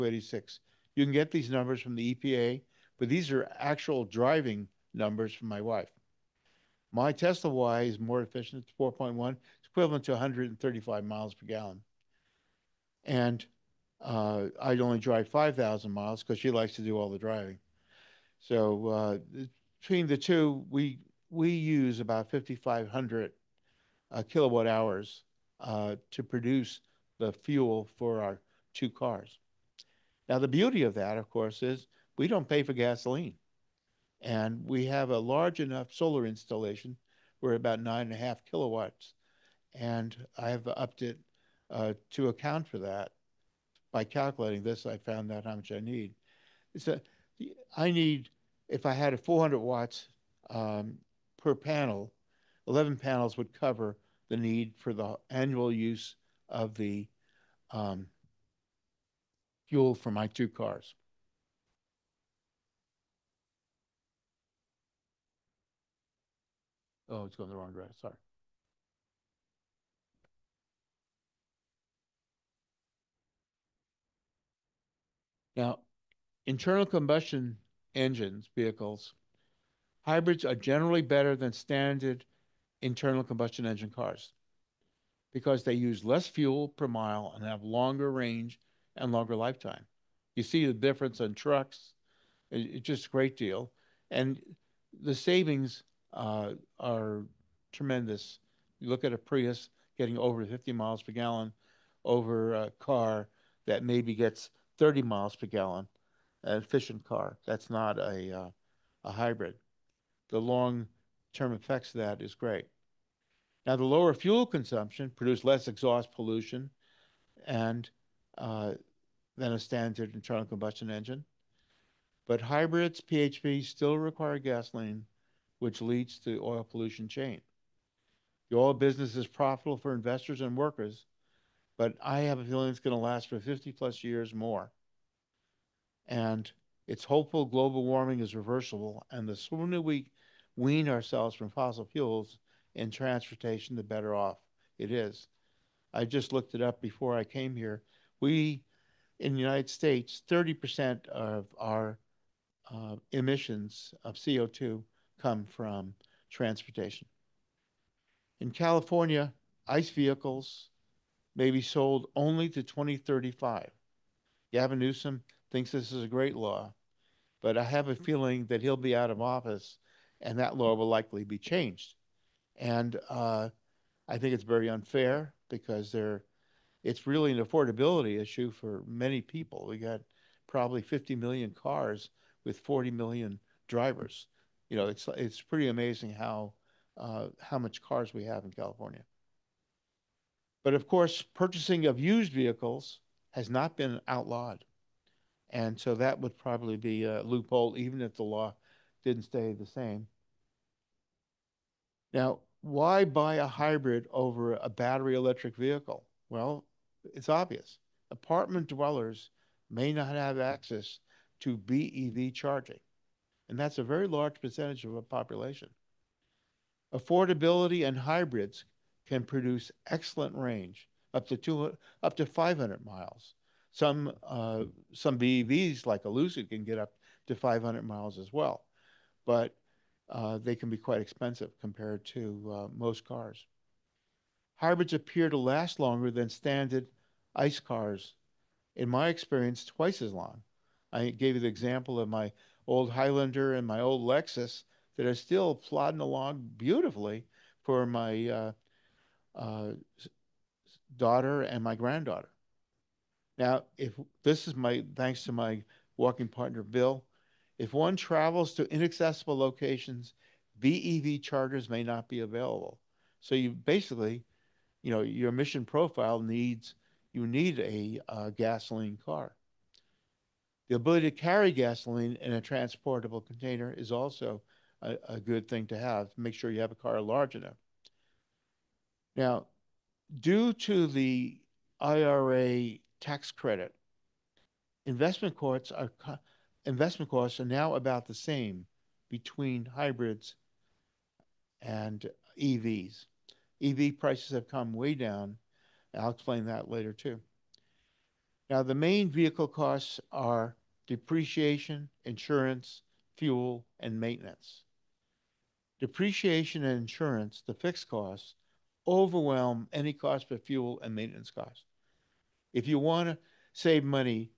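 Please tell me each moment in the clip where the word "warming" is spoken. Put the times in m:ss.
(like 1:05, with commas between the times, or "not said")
2:17.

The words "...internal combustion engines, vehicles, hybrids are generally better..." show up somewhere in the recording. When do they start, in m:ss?
1:16.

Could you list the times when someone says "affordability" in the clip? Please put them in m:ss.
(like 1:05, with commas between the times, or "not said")
2:57, 3:36.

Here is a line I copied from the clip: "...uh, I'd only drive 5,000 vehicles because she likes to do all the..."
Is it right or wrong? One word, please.
wrong.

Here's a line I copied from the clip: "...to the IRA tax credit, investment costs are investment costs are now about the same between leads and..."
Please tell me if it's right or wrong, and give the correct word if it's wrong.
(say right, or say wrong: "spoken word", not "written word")
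wrong: "hybrids", not "leads".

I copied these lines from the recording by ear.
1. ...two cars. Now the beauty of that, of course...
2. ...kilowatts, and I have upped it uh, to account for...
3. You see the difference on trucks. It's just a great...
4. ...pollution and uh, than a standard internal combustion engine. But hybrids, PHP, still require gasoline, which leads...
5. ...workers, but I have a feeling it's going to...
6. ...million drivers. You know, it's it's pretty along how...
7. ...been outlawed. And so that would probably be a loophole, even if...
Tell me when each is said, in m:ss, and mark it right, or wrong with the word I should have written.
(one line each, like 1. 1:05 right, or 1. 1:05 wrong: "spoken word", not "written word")
1. 0:28 right
2. 0:38 right
3. 1:30 right
4. 1:56 right
5. 2:10 right
6. 3:02 wrong: "amazing", not "along"
7. 3:13 right.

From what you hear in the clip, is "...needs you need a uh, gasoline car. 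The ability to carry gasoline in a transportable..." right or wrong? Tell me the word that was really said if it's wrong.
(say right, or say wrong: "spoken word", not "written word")
right.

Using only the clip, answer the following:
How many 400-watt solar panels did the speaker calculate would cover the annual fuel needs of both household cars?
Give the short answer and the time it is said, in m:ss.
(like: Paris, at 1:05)
11, at 0:52.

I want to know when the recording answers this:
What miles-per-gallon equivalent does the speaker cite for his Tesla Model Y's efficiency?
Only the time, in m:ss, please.
0:10.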